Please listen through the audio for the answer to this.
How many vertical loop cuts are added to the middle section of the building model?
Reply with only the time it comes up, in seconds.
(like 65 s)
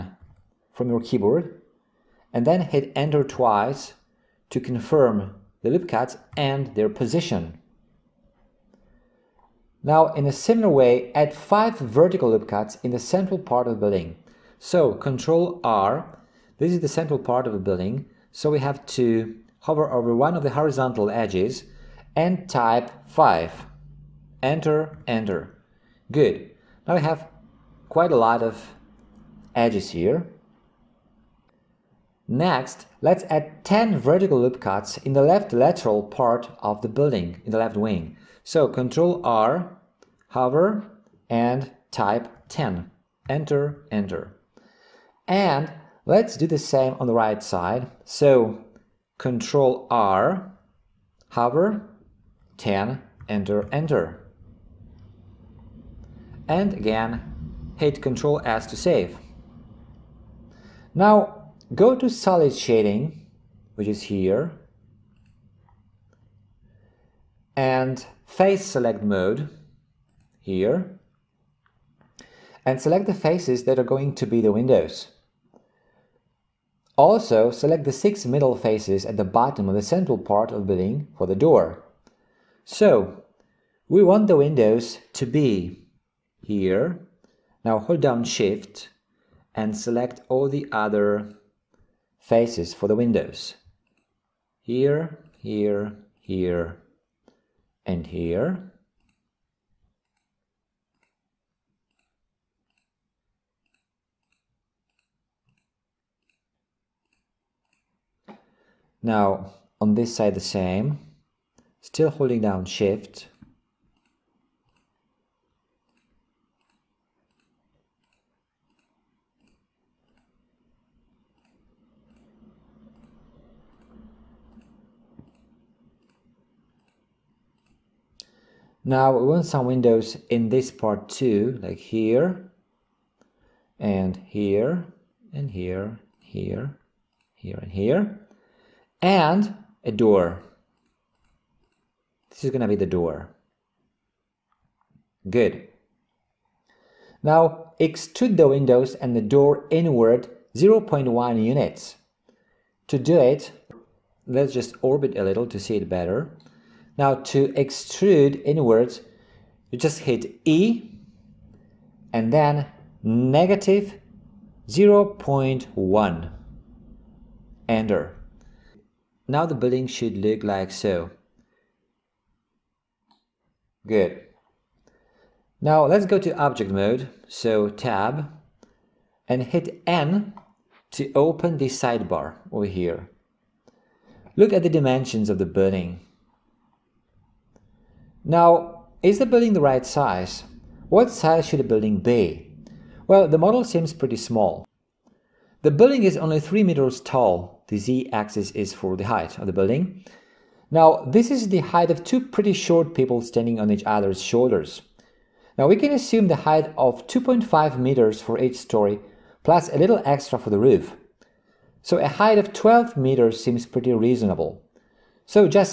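22 s.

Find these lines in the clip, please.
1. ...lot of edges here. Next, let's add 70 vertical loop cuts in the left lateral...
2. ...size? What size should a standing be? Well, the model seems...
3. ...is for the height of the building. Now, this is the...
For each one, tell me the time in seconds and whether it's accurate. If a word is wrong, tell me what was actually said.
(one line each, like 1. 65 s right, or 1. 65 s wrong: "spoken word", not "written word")
1. 28 s wrong: "10", not "70"
2. 189 s wrong: "building", not "standing"
3. 198 s right.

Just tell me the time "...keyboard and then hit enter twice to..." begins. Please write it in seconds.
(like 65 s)
0 s.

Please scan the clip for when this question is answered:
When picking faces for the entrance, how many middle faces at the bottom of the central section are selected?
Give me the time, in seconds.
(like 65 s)
77 s.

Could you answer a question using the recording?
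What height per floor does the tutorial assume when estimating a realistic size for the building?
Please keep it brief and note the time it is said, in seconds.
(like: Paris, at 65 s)
2.5 meters, at 207 s.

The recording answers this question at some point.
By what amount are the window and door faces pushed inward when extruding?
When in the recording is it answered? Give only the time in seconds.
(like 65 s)
150 s.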